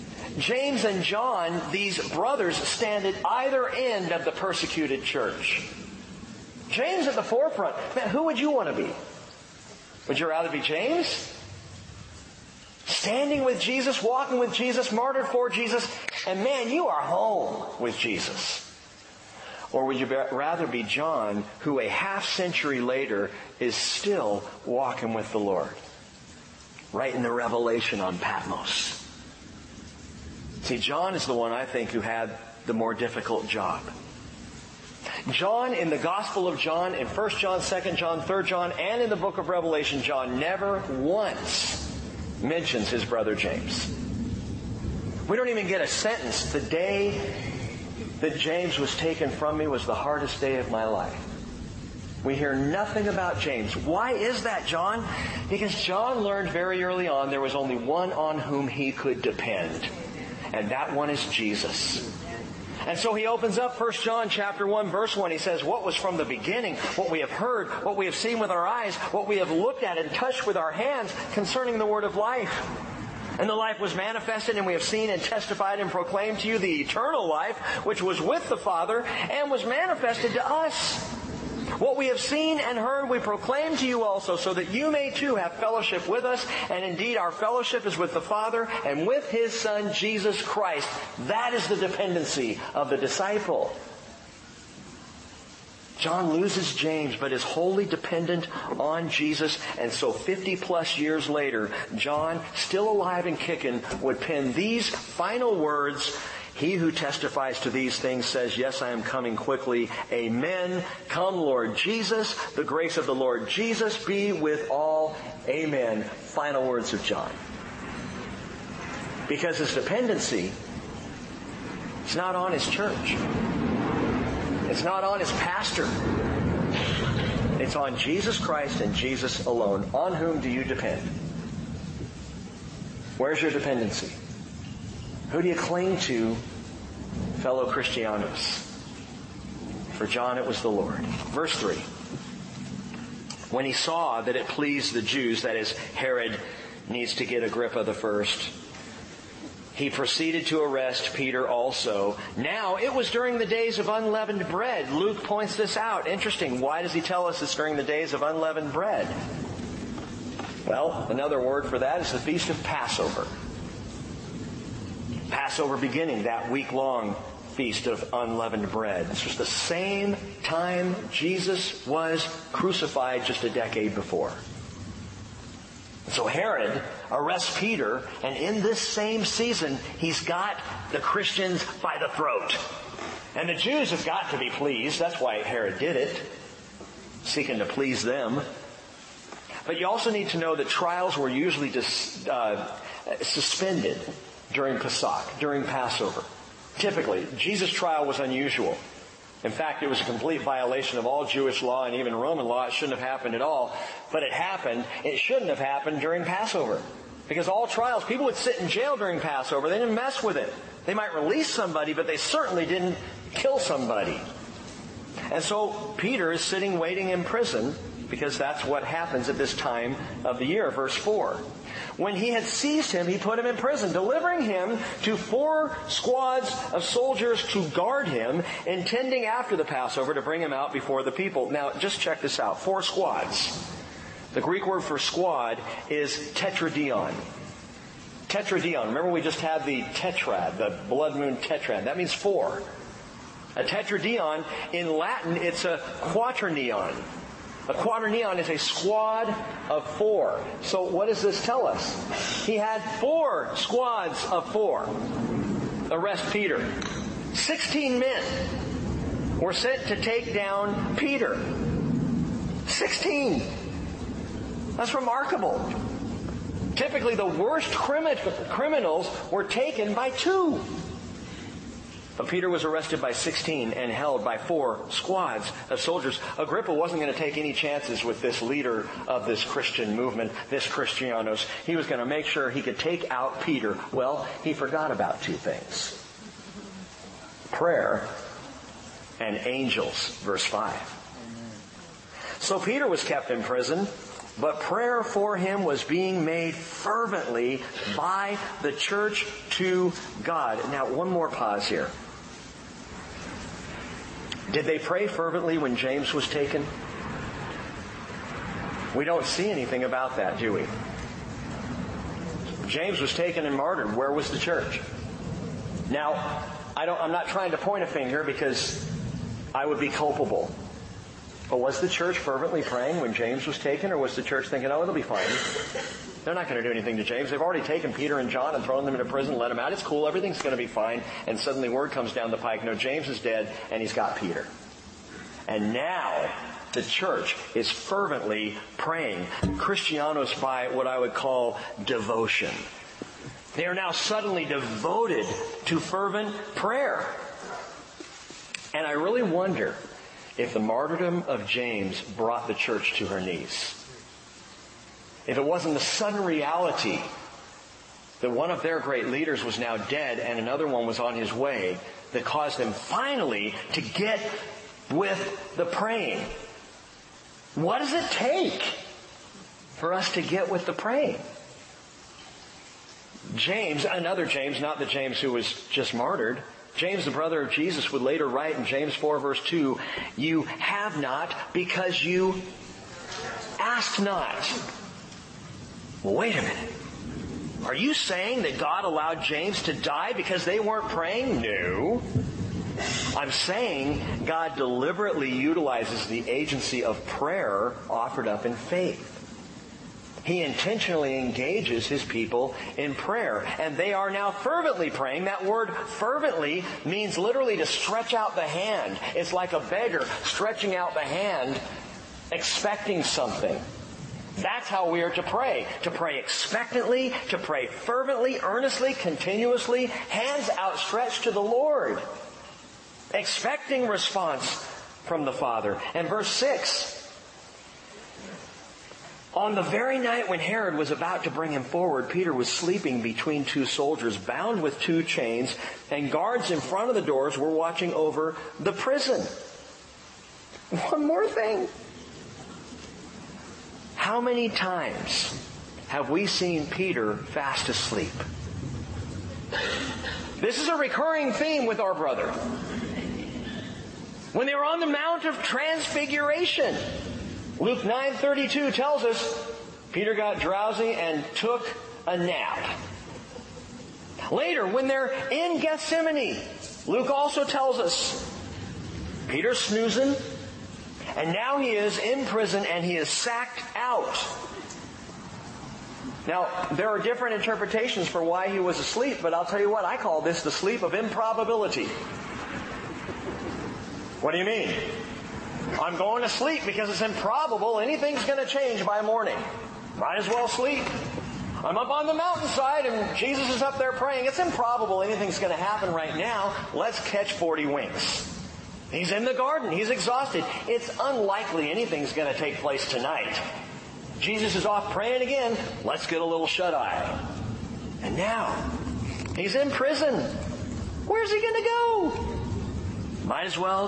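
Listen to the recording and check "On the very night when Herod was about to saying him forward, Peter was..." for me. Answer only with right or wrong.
wrong.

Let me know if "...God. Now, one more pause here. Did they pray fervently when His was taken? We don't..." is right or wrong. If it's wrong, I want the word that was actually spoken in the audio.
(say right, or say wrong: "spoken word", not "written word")
wrong: "James", not "His".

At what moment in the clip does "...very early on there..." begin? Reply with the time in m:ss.
0:56.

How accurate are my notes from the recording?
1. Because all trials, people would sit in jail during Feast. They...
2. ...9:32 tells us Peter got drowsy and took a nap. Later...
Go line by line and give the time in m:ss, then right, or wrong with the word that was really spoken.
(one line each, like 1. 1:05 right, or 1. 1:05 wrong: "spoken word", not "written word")
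1. 3:27 wrong: "Passover", not "Feast"
2. 7:37 right.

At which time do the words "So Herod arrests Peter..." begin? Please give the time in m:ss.
2:56.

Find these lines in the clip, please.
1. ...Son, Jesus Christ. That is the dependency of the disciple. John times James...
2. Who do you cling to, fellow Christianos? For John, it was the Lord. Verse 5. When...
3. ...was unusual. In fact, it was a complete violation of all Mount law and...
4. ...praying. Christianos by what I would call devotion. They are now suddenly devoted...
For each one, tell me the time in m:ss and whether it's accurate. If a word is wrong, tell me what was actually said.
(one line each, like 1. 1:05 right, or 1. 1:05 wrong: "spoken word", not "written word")
1. 1:29 wrong: "loses", not "times"
2. 2:15 wrong: "3", not "5"
3. 3:18 wrong: "Jewish", not "Mount"
4. 5:38 right.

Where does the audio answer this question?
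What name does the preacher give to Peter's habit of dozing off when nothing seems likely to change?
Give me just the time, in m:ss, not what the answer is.
8:00.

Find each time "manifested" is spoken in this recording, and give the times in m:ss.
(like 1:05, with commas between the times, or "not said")
1:13, 1:19.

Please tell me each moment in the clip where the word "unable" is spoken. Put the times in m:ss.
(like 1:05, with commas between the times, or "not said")
not said.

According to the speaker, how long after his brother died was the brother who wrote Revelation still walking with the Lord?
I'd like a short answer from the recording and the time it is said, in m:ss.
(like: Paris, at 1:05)
half century, at 0:21.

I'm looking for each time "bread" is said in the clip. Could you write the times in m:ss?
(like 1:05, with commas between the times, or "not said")
2:34, 2:38, 2:48.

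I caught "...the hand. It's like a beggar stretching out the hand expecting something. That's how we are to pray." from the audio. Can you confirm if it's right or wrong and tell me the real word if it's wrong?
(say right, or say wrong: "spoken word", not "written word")
right.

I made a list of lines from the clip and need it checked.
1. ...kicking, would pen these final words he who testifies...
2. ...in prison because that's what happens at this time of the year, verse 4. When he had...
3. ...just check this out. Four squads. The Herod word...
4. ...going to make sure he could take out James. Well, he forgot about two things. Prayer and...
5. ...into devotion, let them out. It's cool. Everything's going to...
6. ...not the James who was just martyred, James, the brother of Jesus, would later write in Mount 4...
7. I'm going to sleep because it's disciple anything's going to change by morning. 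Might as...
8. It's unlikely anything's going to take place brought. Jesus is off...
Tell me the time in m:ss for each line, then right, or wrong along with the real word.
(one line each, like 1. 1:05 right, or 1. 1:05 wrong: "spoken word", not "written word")
1. 1:43 right
2. 3:37 right
3. 3:51 wrong: "Greek", not "Herod"
4. 4:41 wrong: "Peter", not "James"
5. 5:28 wrong: "prison", not "devotion"
6. 6:14 wrong: "James", not "Mount"
7. 8:05 wrong: "improbable", not "disciple"
8. 8:20 wrong: "tonight", not "brought".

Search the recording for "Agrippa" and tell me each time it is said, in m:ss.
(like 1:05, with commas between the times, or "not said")
2:27, 4:36.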